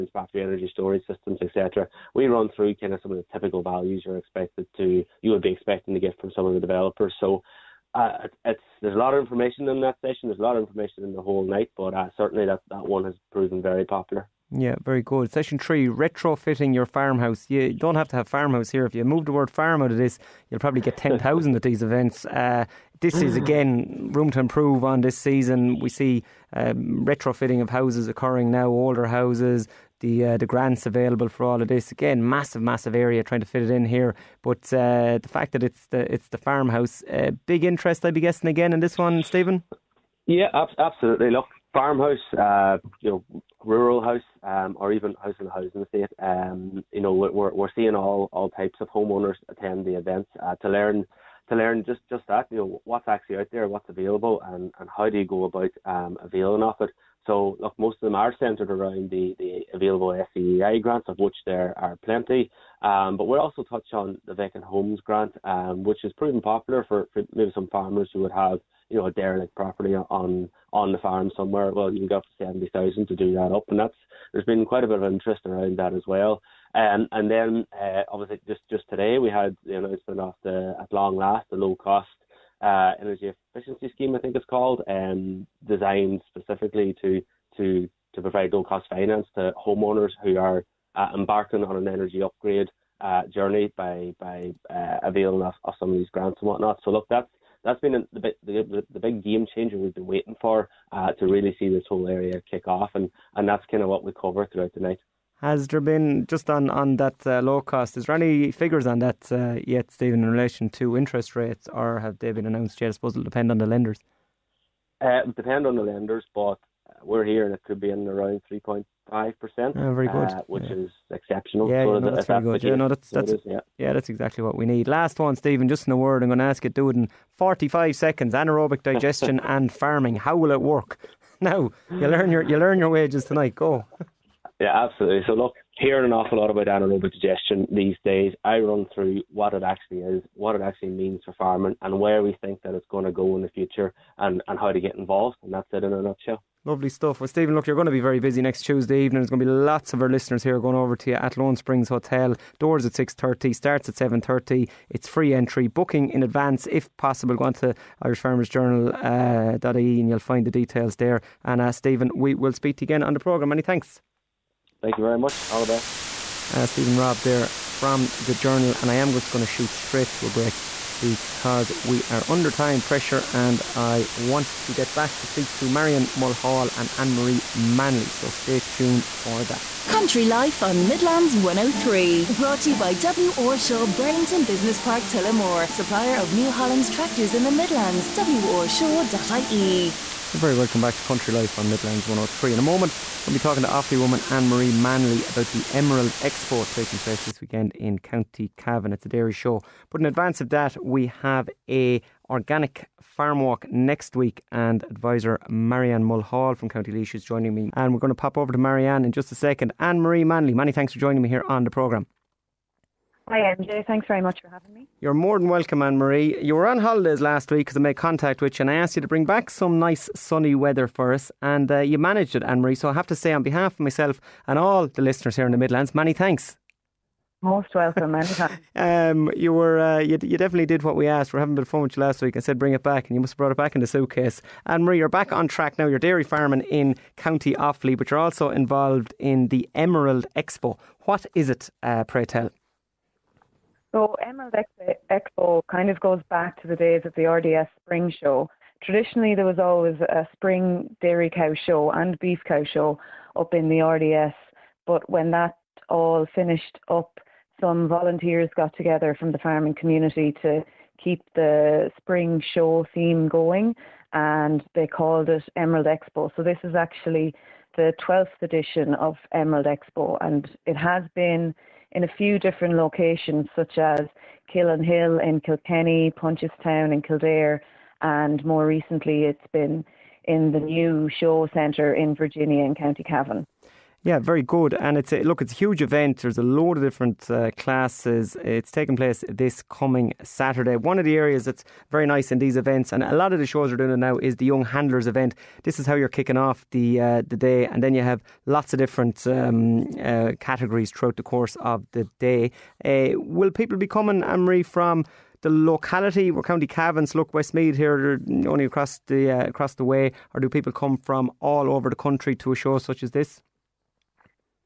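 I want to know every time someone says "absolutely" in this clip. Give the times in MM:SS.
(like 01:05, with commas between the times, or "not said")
00:40, 02:14.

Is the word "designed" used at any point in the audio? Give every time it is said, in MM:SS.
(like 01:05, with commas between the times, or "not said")
01:25.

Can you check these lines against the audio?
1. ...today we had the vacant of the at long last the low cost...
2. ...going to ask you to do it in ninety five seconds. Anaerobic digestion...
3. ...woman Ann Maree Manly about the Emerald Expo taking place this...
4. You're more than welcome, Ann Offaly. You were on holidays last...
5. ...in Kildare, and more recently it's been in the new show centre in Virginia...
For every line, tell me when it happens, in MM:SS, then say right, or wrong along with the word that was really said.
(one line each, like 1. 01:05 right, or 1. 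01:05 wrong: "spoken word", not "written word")
1. 01:18 wrong: "announcement", not "vacant"
2. 02:06 wrong: "forty", not "ninety"
3. 03:13 right
4. 03:34 wrong: "Maree", not "Offaly"
5. 04:36 right.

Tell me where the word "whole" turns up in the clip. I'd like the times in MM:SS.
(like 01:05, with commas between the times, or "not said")
00:11, 01:41.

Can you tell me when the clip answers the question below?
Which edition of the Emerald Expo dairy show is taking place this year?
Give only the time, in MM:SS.
04:28.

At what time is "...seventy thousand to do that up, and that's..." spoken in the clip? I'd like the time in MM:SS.
01:12.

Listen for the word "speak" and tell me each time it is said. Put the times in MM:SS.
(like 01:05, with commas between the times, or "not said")
02:42, 02:55.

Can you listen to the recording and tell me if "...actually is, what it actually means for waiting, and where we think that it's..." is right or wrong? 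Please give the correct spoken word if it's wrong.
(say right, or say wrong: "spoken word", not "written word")
wrong: "farming", not "waiting".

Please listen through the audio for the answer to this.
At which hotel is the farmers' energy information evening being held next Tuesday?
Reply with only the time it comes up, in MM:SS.
02:31.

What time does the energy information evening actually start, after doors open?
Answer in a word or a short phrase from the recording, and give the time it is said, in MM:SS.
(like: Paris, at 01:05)
7.30, at 02:33.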